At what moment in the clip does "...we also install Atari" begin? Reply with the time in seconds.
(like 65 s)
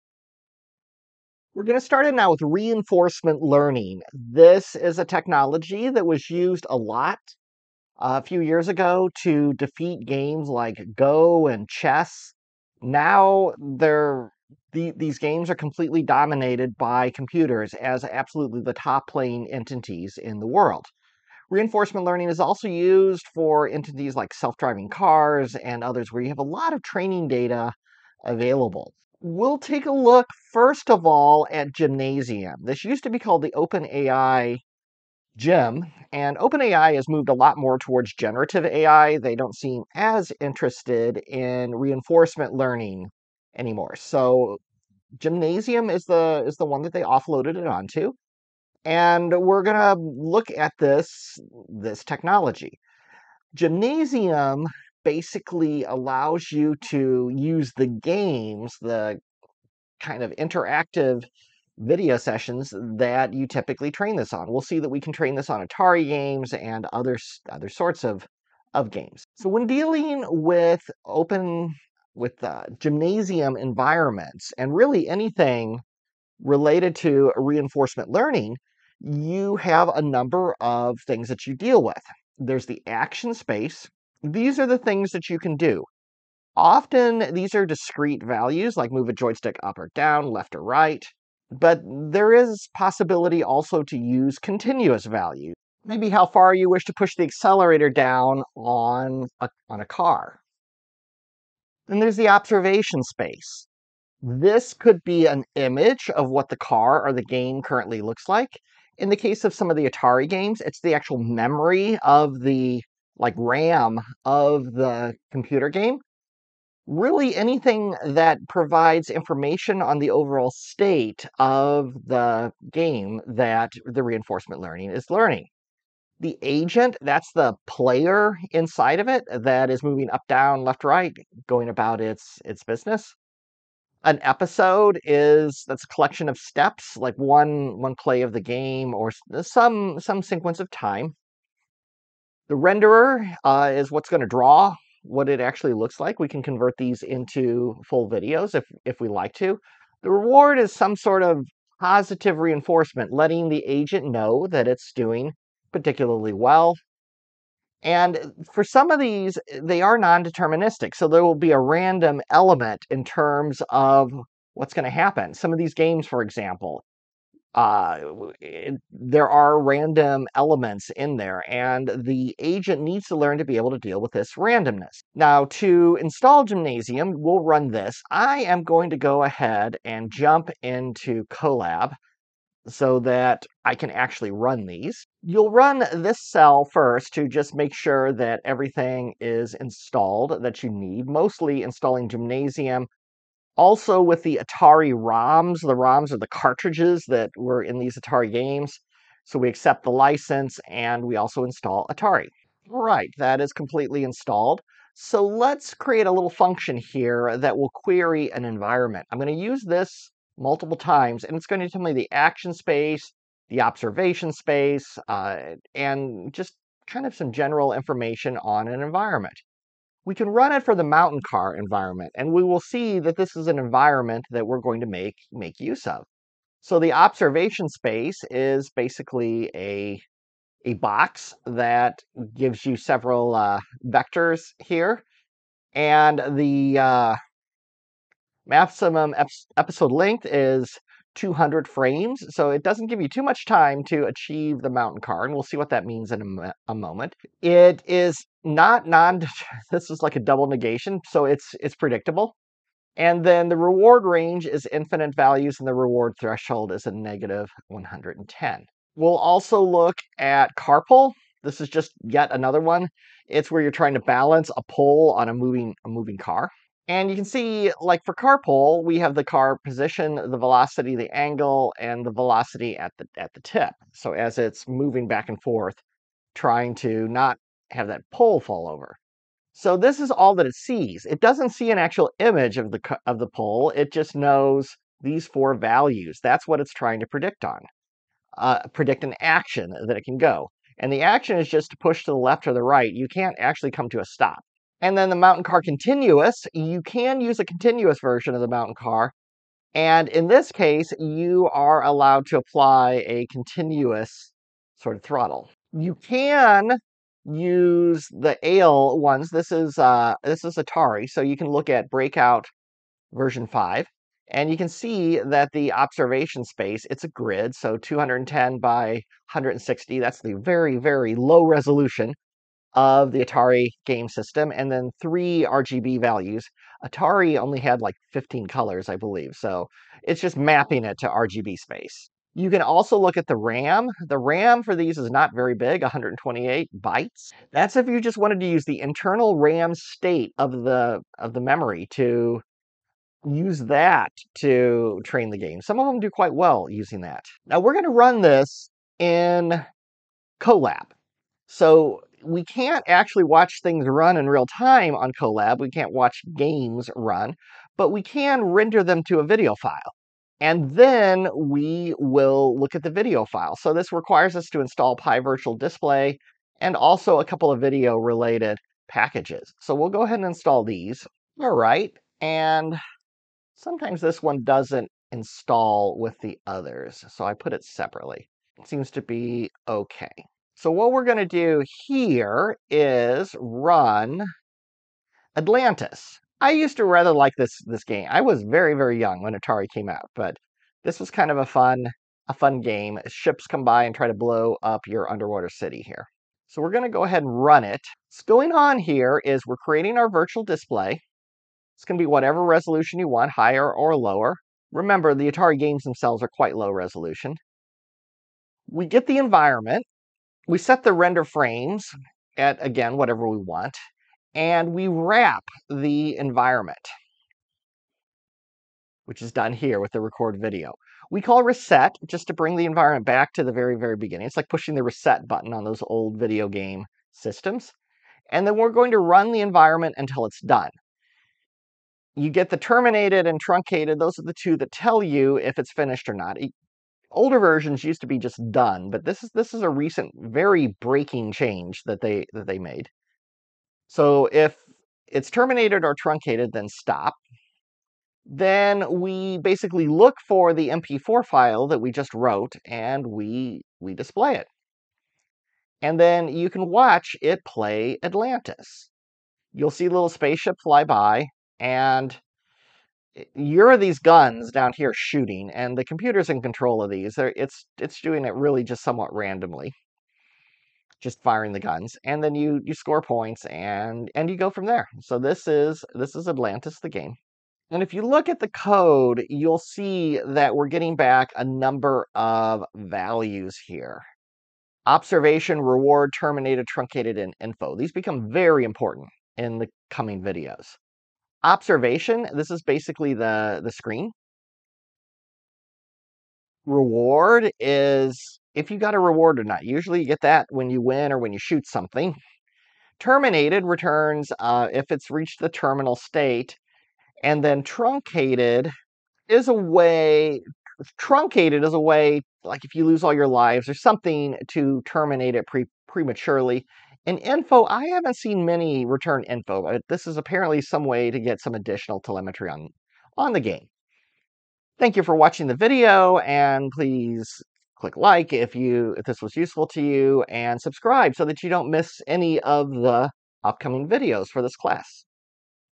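201 s.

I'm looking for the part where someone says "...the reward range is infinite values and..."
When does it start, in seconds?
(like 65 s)
253 s.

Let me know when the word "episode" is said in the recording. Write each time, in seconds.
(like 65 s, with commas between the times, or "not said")
134 s, 239 s.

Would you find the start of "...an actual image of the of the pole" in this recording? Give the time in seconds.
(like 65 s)
281 s.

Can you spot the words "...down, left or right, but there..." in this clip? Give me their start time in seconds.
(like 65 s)
89 s.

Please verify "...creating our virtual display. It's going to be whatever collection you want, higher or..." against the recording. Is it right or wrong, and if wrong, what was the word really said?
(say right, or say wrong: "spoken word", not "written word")
wrong: "resolution", not "collection".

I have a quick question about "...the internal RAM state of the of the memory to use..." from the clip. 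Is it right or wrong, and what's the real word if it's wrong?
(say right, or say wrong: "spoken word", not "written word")
right.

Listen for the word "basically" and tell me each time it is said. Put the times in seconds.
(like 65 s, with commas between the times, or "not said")
55 s, 228 s, 449 s, 492 s.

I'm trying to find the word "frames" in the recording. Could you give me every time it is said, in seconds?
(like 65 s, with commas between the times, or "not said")
241 s, 411 s.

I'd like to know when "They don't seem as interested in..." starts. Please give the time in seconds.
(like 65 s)
39 s.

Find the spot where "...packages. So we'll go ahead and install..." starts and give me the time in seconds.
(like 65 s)
368 s.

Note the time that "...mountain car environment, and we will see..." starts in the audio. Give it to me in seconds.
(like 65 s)
220 s.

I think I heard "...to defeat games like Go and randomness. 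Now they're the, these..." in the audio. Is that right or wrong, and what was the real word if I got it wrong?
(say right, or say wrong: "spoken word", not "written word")
wrong: "chess", not "randomness".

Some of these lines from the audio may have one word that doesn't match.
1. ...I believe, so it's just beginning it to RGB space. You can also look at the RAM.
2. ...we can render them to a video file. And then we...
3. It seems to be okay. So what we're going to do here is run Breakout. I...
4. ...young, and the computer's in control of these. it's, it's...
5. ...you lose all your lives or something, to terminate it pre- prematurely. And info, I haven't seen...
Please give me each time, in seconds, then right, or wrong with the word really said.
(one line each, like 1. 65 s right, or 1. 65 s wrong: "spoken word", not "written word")
1. 328 s wrong: "mapping", not "beginning"
2. 357 s right
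3. 378 s wrong: "Atlantis", not "Breakout"
4. 464 s wrong: "shooting", not "young"
5. 512 s right.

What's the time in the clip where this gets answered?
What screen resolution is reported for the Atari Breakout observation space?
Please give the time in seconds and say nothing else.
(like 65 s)
317 s.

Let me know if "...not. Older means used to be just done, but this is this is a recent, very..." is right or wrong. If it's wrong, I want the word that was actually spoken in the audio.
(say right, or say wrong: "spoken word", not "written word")
wrong: "versions", not "means".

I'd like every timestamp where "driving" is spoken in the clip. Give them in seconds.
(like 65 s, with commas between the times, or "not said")
24 s.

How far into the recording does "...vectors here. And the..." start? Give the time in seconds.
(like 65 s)
233 s.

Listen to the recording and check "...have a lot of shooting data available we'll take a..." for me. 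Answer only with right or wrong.
wrong.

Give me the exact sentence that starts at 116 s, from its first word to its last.
Really, anything that provides information on the overall state of the game that the reinforcement learning is learning.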